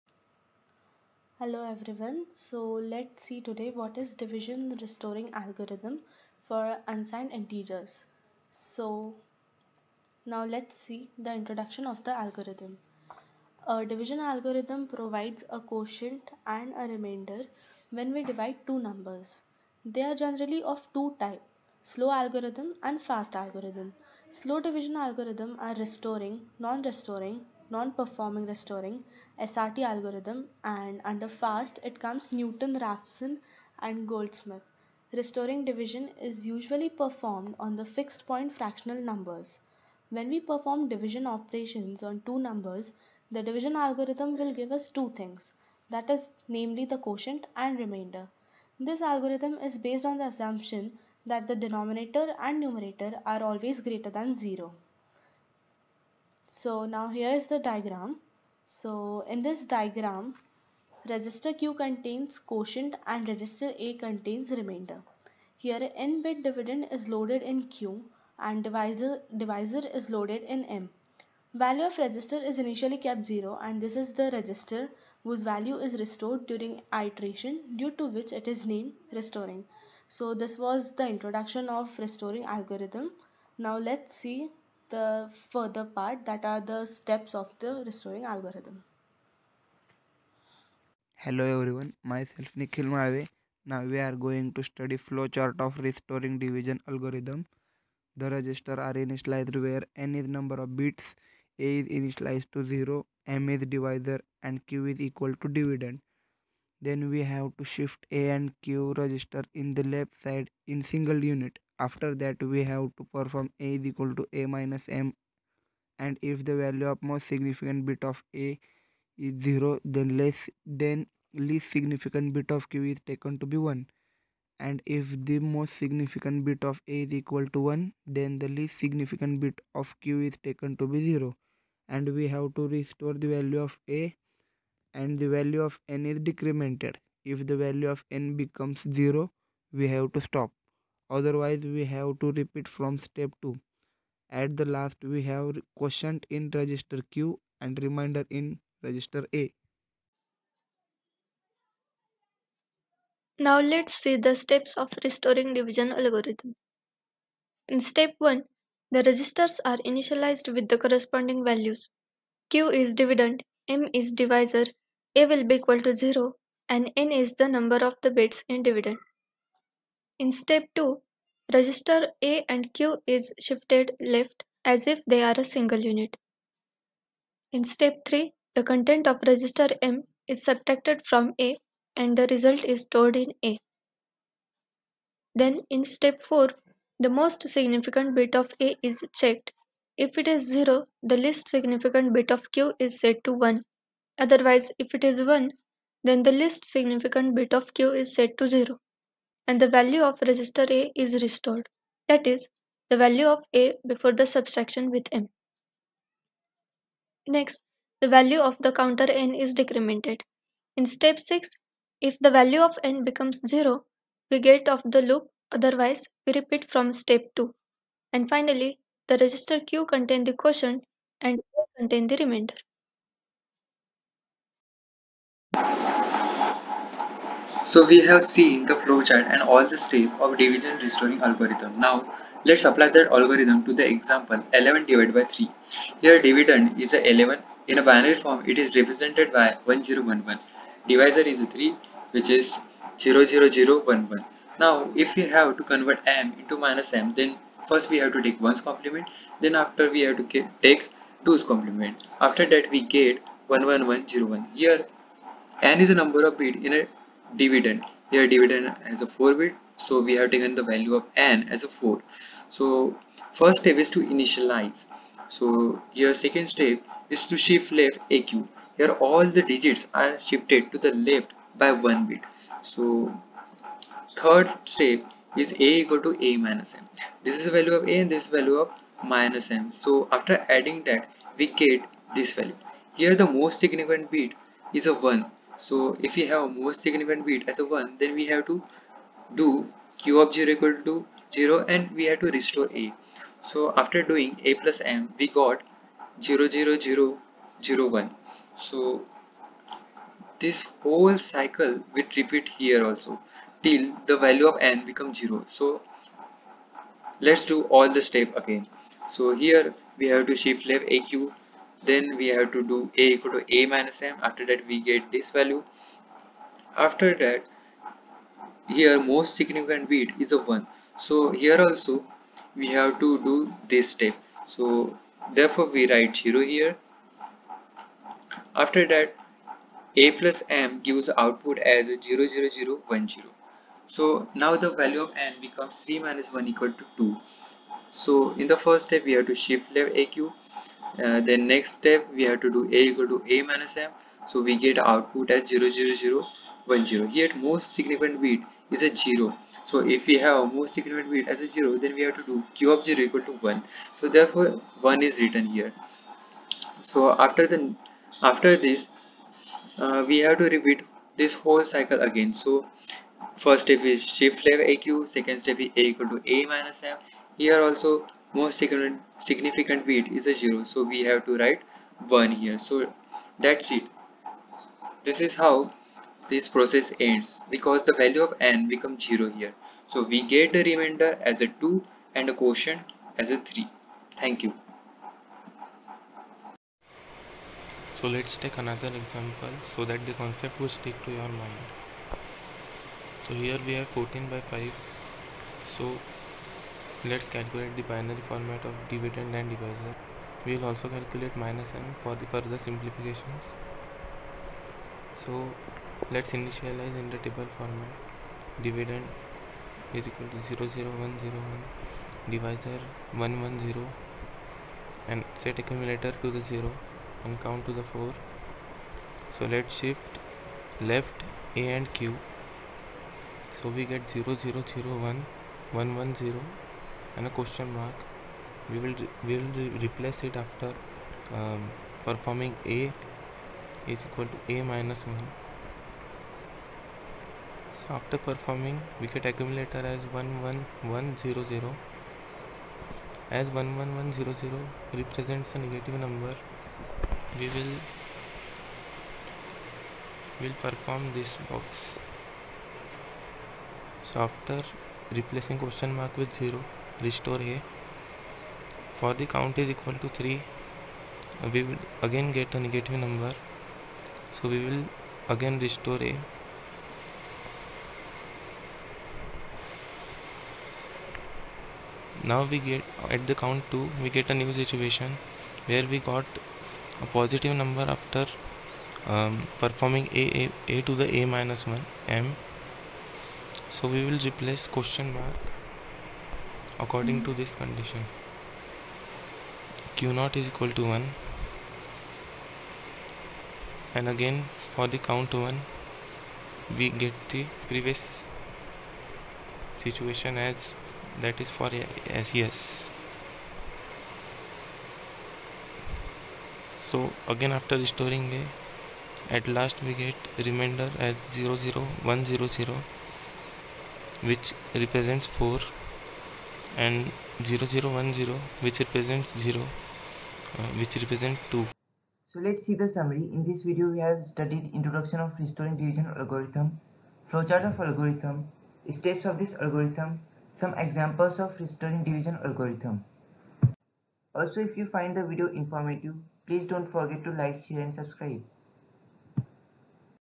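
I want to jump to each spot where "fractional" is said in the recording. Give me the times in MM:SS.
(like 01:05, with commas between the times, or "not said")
00:38.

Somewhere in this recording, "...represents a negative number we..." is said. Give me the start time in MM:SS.
07:25.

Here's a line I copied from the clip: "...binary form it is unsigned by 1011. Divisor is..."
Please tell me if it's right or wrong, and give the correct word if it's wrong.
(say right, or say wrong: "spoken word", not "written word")
wrong: "represented", not "unsigned".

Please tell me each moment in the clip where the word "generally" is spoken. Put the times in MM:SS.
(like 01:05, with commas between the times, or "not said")
00:20.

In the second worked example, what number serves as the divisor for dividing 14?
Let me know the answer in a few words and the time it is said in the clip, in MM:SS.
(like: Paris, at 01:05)
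5, at 06:34.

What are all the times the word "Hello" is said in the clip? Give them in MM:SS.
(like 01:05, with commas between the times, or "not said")
00:01, 01:31.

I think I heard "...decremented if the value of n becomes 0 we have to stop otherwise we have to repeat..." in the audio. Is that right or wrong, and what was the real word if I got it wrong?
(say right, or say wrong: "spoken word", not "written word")
right.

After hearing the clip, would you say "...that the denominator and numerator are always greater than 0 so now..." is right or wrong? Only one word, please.
right.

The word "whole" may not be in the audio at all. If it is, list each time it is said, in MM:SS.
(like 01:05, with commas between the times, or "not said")
05:00, 06:01.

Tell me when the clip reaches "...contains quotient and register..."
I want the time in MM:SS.
01:01.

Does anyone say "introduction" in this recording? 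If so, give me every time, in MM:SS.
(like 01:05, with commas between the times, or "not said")
00:11, 01:21, 08:44.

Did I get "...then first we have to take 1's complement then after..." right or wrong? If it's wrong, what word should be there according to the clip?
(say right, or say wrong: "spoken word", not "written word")
right.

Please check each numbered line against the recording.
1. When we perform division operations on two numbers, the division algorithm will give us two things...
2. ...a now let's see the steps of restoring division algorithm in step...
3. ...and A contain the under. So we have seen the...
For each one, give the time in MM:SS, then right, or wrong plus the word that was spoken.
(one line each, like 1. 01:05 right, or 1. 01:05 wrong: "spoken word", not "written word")
1. 00:40 right
2. 02:29 right
3. 03:41 wrong: "remainder", not "under".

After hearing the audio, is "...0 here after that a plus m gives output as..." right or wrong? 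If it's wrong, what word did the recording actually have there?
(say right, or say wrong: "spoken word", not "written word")
right.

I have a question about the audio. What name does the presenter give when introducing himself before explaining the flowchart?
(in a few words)
Nikhil Malave.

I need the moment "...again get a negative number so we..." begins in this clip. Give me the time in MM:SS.
07:42.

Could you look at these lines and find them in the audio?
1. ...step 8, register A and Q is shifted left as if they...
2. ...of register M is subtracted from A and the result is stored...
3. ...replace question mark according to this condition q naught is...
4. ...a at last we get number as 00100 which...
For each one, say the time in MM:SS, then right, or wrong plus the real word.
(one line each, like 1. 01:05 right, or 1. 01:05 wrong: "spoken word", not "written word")
1. 02:50 wrong: "2", not "8"
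2. 02:59 right
3. 08:04 right
4. 08:28 wrong: "remainder", not "number".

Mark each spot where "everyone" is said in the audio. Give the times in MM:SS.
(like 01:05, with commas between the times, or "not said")
00:01, 01:31.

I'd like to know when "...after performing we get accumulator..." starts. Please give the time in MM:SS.
07:17.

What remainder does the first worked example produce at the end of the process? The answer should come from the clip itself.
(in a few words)
2.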